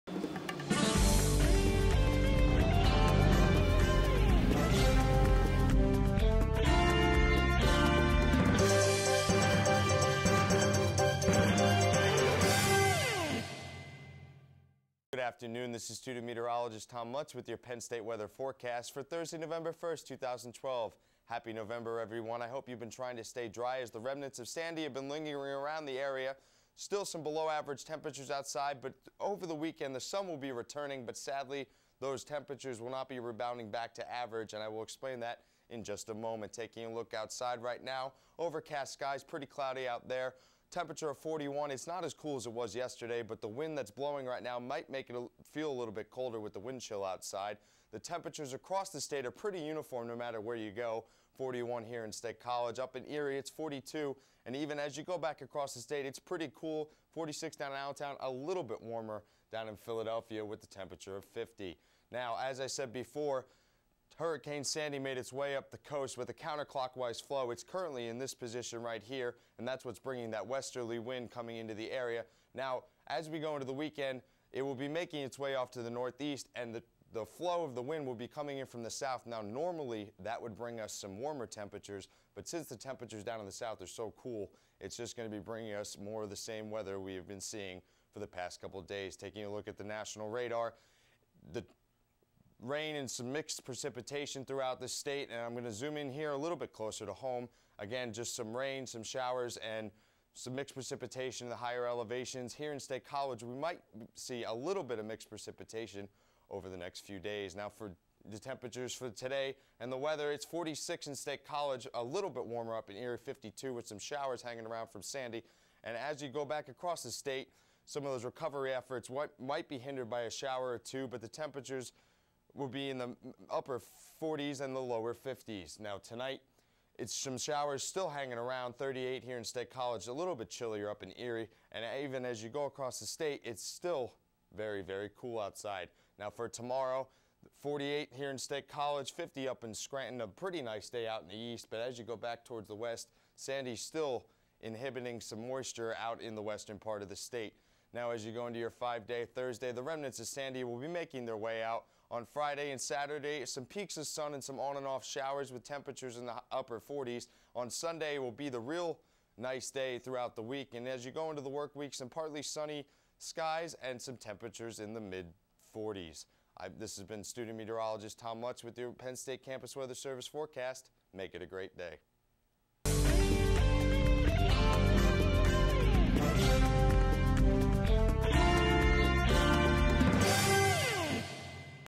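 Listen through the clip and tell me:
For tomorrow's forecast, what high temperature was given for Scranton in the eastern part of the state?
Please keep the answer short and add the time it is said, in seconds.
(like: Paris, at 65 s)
50, at 139 s.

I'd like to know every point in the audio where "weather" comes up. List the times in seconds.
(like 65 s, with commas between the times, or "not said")
18 s, 86 s, 109 s, 169 s.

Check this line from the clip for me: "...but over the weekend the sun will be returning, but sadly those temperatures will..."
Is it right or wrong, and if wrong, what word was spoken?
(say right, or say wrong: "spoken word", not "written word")
right.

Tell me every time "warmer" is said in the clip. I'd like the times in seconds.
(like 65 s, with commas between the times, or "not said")
58 s, 81 s, 112 s.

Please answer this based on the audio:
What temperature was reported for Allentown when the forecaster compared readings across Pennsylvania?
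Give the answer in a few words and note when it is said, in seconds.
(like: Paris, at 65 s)
46, at 57 s.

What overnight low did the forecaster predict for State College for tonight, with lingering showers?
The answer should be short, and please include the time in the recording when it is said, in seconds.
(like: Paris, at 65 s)
38, at 128 s.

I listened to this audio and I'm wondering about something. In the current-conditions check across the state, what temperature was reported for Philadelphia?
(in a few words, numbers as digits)
50.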